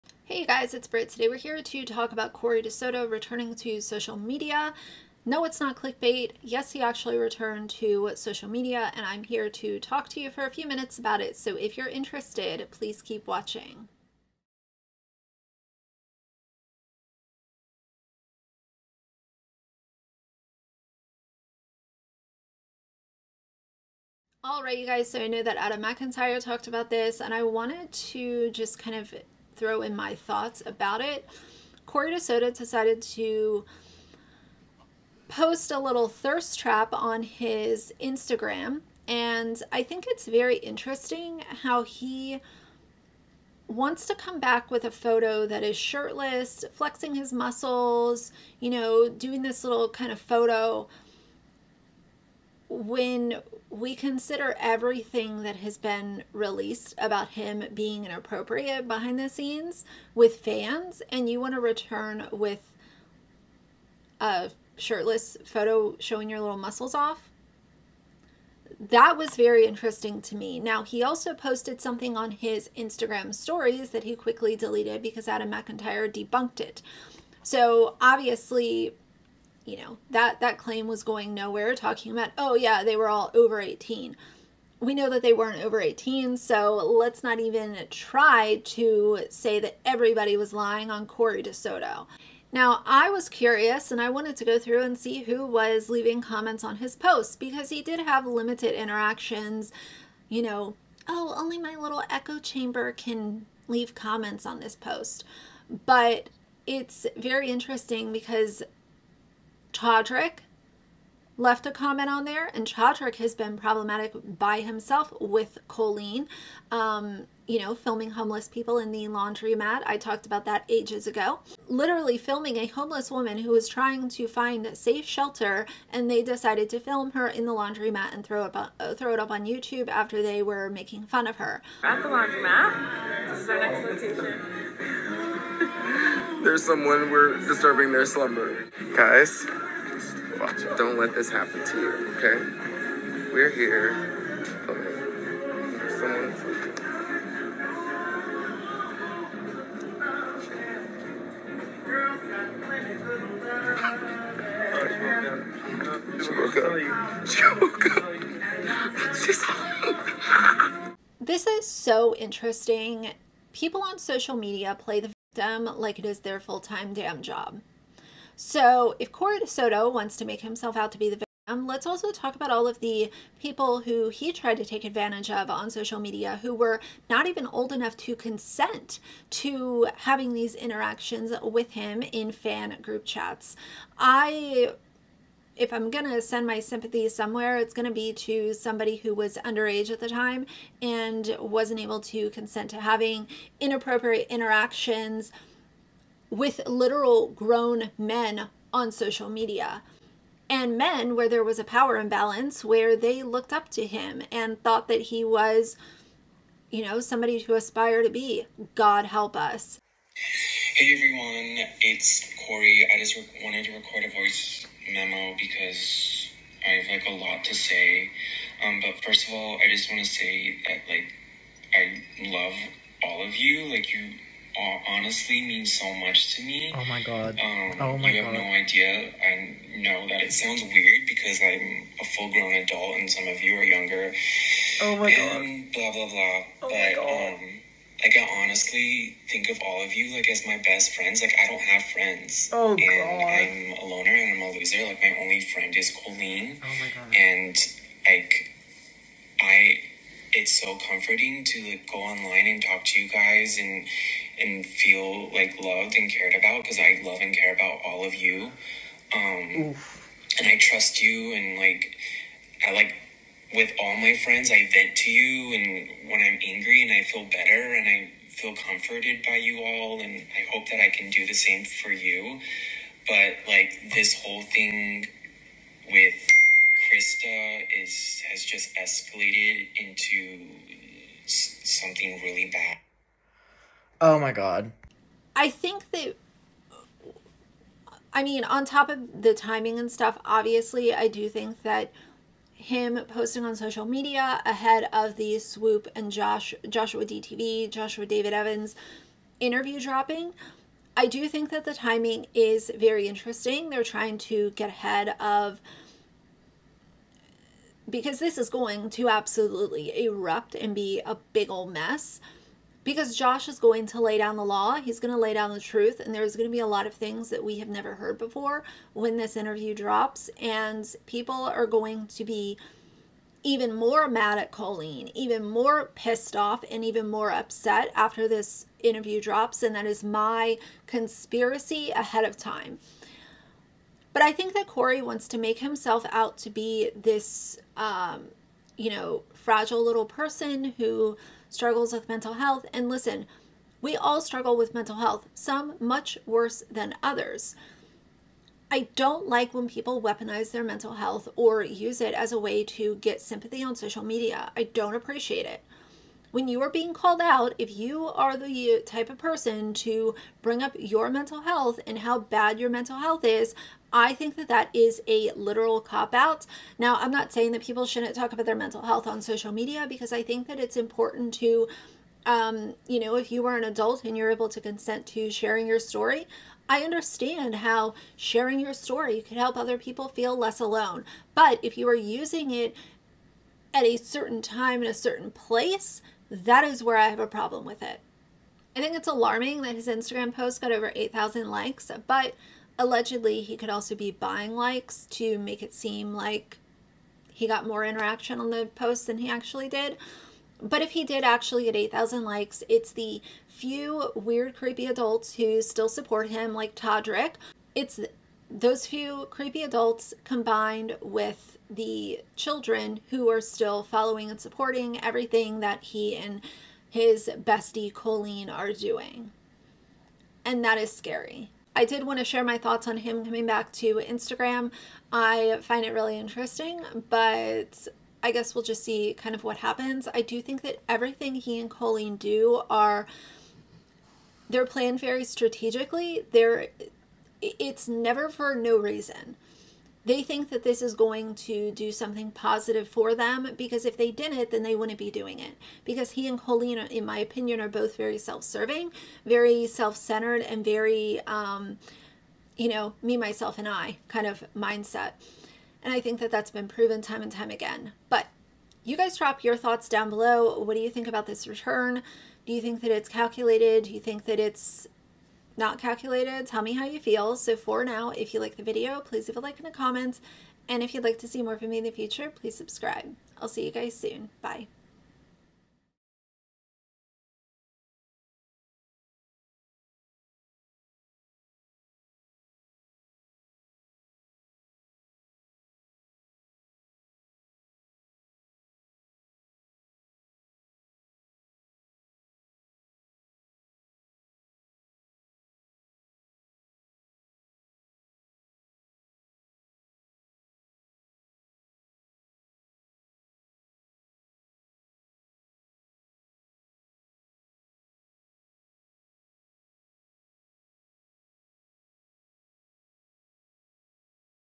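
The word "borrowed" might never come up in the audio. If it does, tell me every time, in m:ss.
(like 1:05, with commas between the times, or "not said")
not said.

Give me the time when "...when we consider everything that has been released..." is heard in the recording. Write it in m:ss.
0:52.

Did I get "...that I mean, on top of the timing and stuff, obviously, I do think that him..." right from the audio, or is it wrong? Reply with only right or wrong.
right.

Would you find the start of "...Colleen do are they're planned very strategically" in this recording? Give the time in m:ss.
7:11.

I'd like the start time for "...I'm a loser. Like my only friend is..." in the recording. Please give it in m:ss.
4:04.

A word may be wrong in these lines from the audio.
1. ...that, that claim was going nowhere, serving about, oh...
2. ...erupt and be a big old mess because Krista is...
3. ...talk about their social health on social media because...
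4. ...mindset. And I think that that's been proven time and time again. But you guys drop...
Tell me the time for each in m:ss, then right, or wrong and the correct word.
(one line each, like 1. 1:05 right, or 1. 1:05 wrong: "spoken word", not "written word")
1. 1:20 wrong: "talking", not "serving"
2. 5:10 wrong: "Josh", not "Krista"
3. 6:08 wrong: "mental", not "social"
4. 7:34 right.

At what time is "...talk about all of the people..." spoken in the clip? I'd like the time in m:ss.
2:52.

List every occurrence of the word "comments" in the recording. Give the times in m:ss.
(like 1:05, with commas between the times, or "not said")
1:36, 1:43, 1:51, 7:49.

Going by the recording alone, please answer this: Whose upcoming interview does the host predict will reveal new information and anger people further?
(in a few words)
Joshua David Evans.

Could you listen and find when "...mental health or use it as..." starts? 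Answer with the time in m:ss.
5:50.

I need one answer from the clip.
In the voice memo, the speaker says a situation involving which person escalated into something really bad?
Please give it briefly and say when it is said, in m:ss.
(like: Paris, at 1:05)
Krista, at 4:36.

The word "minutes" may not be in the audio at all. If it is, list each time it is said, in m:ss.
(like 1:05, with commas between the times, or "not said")
0:10.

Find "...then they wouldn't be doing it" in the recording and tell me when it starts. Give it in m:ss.
7:24.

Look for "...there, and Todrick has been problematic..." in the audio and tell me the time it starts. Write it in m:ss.
1:52.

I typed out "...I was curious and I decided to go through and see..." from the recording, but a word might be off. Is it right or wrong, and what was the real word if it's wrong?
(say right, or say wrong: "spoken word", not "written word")
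wrong: "wanted", not "decided".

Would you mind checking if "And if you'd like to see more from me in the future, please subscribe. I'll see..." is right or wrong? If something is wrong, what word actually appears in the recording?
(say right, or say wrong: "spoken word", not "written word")
right.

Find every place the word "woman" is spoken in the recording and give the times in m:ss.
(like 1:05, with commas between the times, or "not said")
2:03.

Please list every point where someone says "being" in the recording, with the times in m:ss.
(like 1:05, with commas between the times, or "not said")
0:57, 5:56.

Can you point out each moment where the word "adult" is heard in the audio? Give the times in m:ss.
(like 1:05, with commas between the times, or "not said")
3:52, 6:13, 6:44, 6:49.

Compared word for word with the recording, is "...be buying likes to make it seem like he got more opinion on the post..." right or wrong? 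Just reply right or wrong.
wrong.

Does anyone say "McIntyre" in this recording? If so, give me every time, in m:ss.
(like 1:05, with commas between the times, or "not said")
0:25, 1:15.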